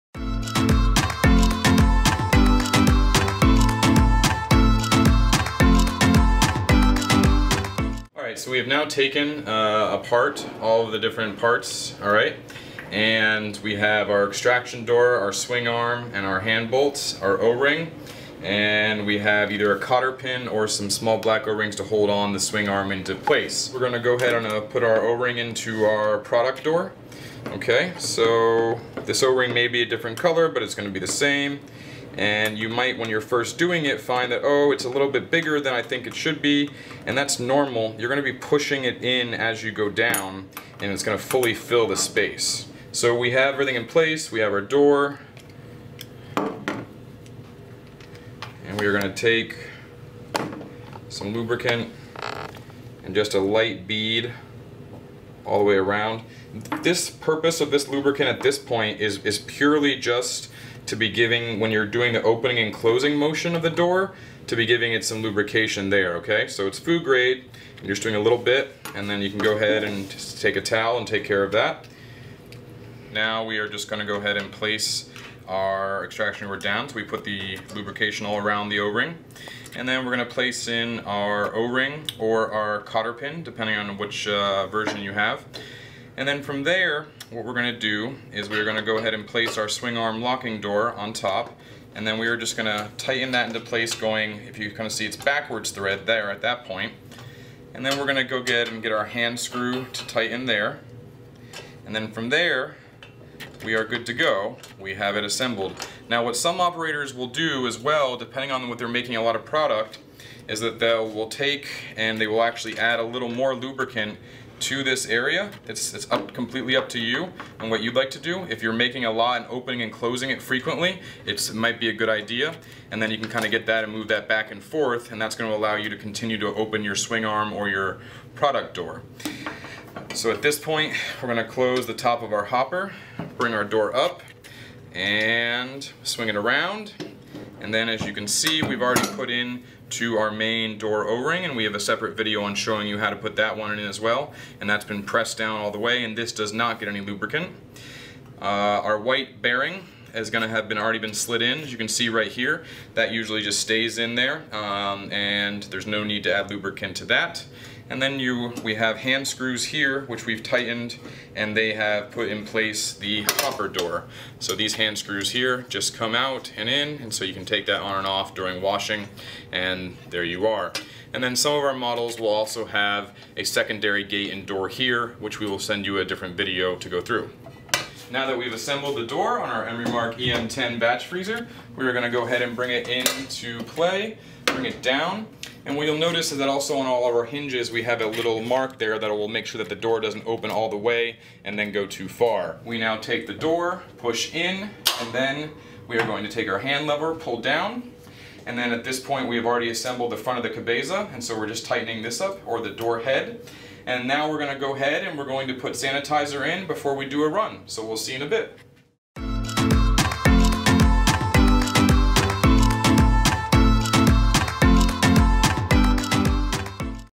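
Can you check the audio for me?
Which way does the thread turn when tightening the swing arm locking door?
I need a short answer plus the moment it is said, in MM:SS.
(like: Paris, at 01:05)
Backwards, at 01:35.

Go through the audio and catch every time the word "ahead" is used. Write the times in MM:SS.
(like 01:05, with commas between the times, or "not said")
00:24, 01:09, 01:14, 01:28, 03:02, 03:24.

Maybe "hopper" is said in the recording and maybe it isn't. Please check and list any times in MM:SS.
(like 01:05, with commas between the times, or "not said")
02:12, 02:43.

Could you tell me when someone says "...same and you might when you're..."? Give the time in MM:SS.
00:31.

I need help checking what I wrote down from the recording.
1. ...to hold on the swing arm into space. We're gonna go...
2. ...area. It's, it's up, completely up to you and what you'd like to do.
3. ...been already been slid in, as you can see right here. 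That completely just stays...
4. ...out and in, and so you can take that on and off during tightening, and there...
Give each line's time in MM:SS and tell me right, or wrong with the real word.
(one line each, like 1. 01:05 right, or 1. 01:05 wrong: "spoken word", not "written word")
1. 00:21 wrong: "place", not "space"
2. 01:55 right
3. 02:30 wrong: "usually", not "completely"
4. 02:46 wrong: "washing", not "tightening".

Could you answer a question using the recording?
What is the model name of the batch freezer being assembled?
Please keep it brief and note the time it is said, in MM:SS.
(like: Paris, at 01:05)
Emerymark EM10, at 02:59.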